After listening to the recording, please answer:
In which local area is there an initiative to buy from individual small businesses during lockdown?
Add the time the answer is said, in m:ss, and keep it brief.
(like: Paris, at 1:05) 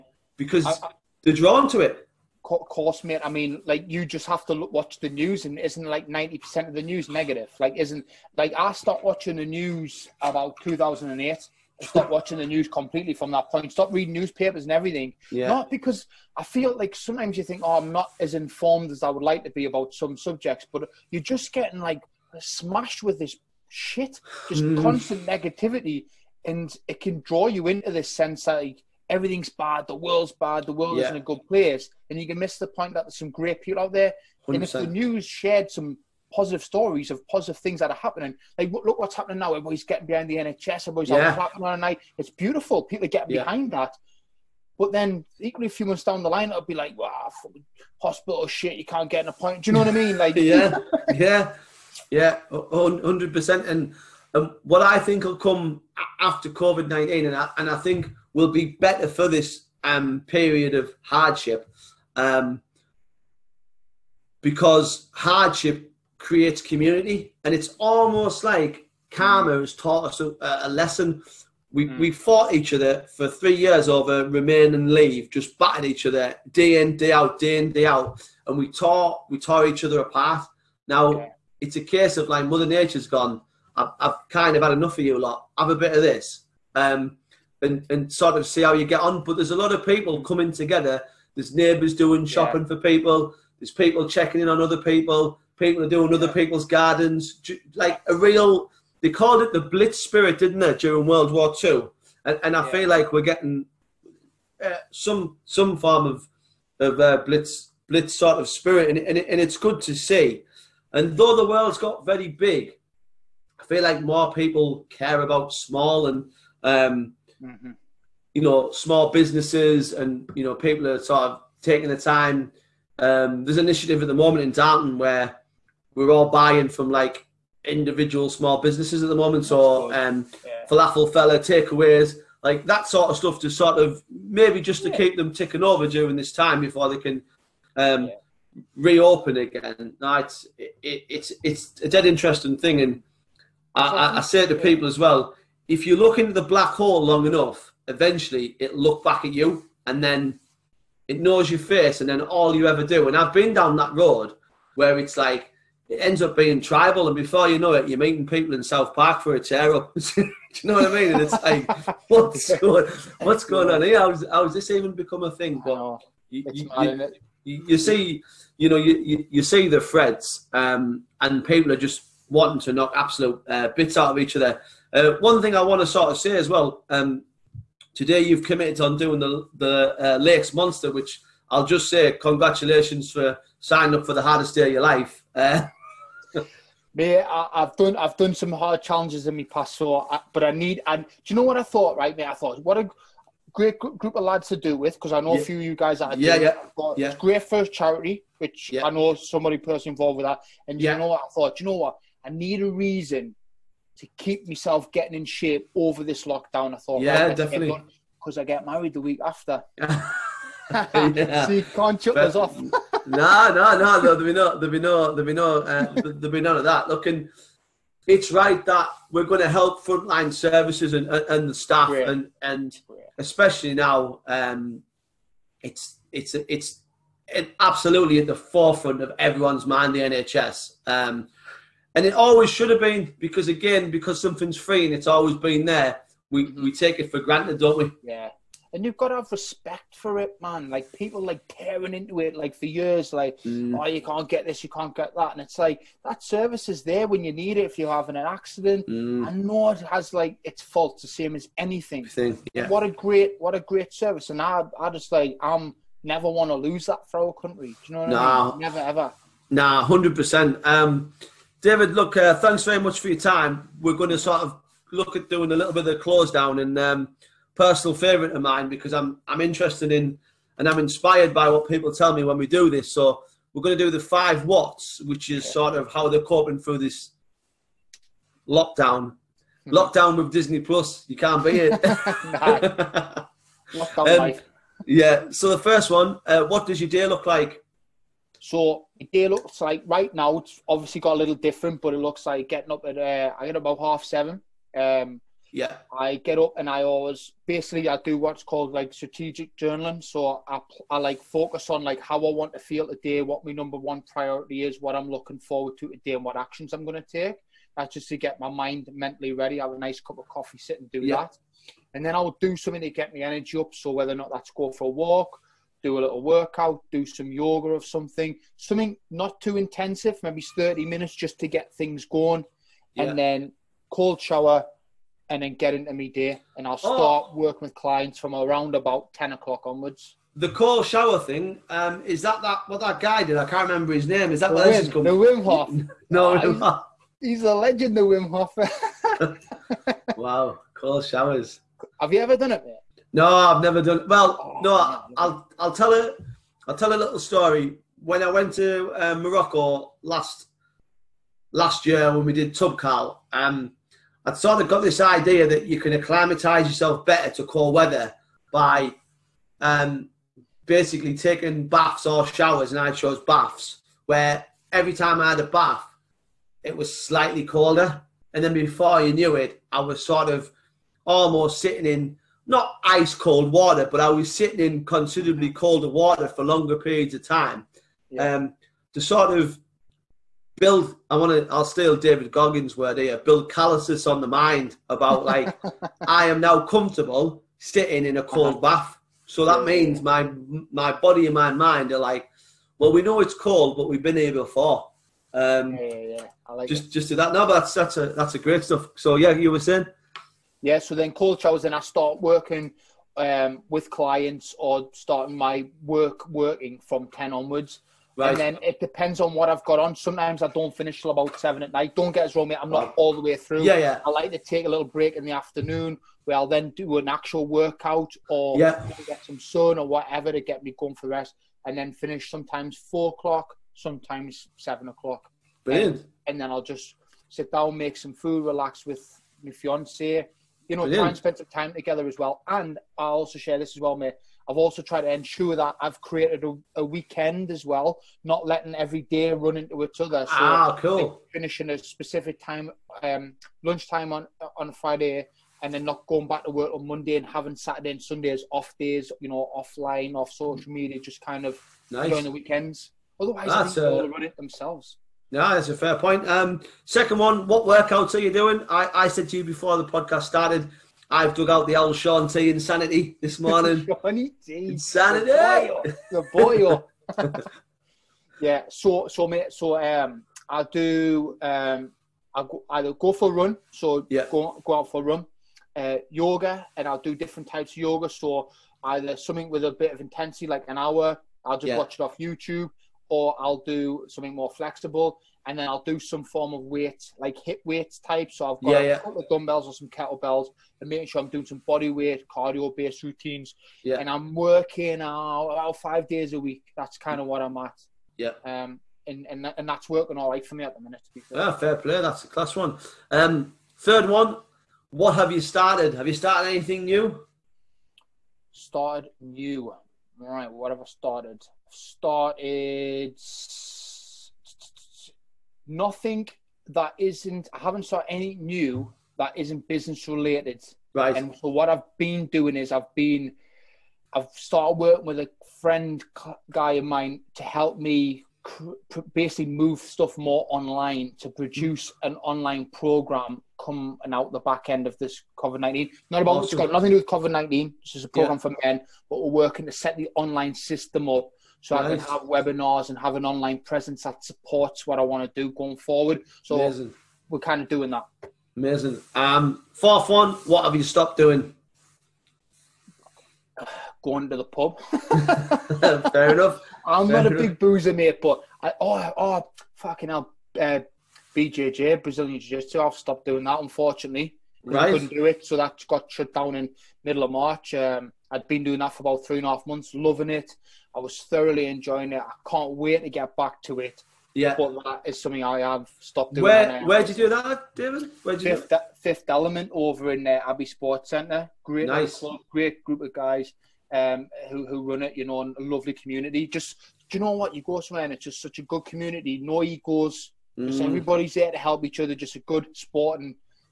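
Darton, at 2:04.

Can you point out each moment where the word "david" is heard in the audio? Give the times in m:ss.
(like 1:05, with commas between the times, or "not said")
4:21, 6:21, 9:37.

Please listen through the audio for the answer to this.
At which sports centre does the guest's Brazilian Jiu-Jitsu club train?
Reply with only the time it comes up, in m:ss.
9:40.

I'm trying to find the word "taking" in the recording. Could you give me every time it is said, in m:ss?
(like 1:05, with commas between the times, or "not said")
2:01, 6:01.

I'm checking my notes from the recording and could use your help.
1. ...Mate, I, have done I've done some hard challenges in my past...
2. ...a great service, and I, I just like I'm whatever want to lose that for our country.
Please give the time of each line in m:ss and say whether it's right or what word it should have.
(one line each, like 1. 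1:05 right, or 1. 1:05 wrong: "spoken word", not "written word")
1. 3:06 right
2. 4:13 wrong: "never", not "whatever".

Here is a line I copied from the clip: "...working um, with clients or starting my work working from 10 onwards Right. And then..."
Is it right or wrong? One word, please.
right.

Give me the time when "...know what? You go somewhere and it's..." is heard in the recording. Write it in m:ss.
9:47.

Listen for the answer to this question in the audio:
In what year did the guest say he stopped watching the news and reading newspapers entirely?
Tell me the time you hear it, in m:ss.
0:10.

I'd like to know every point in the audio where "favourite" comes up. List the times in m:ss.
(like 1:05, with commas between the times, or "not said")
4:27.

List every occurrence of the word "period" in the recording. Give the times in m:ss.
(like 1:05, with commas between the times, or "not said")
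1:00, 6:16.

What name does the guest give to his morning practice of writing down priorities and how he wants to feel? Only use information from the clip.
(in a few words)
strategic journaling.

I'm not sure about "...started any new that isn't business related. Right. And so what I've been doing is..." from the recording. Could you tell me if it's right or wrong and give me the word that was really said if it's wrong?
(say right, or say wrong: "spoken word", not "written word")
right.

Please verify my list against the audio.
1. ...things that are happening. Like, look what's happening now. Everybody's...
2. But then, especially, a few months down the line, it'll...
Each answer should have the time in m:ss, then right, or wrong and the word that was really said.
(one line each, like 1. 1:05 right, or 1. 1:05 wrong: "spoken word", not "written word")
1. 0:37 right
2. 0:44 wrong: "equally", not "especially".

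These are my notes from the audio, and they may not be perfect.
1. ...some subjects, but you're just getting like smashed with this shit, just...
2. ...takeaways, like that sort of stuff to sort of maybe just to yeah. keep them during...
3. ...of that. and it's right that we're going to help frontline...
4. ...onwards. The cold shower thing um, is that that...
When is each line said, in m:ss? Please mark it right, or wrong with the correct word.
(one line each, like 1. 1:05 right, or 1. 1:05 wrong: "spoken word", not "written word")
1. 0:19 right
2. 2:11 wrong: "ticking", not "during"
3. 3:36 right
4. 5:29 right.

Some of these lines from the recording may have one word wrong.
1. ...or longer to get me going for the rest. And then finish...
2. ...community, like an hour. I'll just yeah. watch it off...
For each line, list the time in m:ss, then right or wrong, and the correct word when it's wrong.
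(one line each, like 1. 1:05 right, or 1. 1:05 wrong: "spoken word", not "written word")
1. 6:59 wrong: "whatever", not "longer"
2. 8:00 wrong: "intensity", not "community".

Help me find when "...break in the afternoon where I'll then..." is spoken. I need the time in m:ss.
6:54.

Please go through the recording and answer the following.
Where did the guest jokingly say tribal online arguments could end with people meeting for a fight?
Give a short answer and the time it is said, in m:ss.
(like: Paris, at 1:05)
South Park, at 2:38.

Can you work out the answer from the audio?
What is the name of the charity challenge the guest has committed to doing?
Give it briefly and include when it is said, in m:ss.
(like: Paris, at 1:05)
Lakes Monster, at 3:00.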